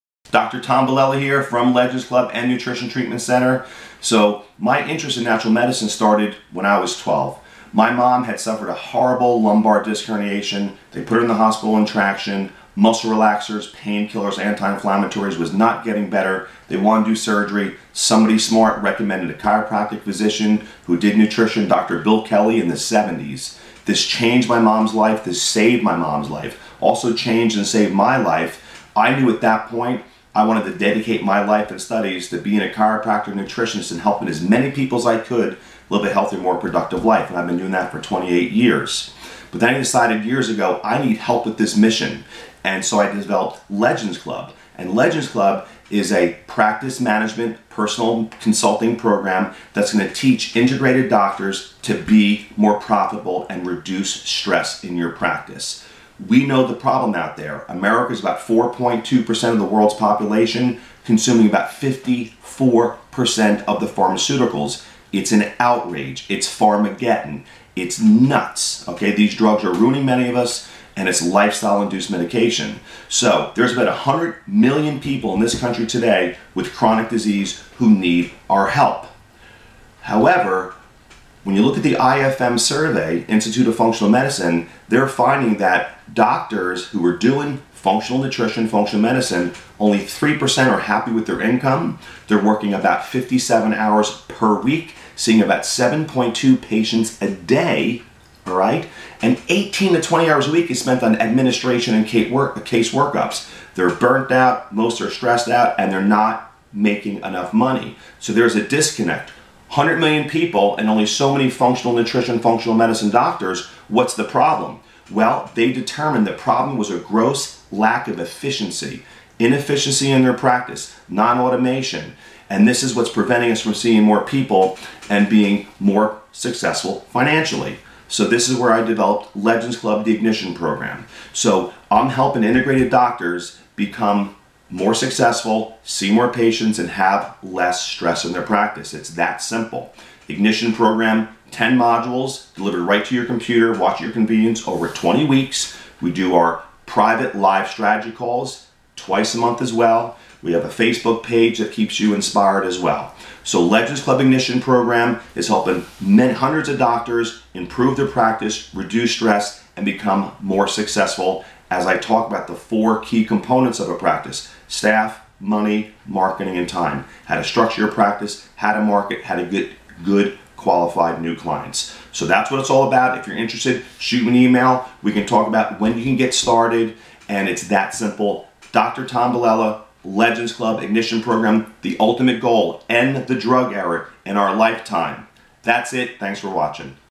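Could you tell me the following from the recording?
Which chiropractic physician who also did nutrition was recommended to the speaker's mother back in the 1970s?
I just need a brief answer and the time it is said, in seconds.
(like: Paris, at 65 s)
Dr. Bill Kelly, at 21 s.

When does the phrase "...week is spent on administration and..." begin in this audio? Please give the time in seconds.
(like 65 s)
100 s.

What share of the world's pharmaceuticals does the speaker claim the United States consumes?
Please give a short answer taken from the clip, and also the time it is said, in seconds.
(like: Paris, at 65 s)
54%, at 61 s.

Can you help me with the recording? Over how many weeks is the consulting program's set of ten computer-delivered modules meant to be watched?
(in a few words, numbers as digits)
20.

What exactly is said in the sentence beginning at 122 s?
And this is what's preventing us from seeing more people and being more successful financially.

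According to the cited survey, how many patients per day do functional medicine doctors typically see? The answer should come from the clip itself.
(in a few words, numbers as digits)
7.2.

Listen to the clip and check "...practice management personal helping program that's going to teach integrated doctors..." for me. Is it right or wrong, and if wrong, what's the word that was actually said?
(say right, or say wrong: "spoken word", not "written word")
wrong: "consulting", not "helping".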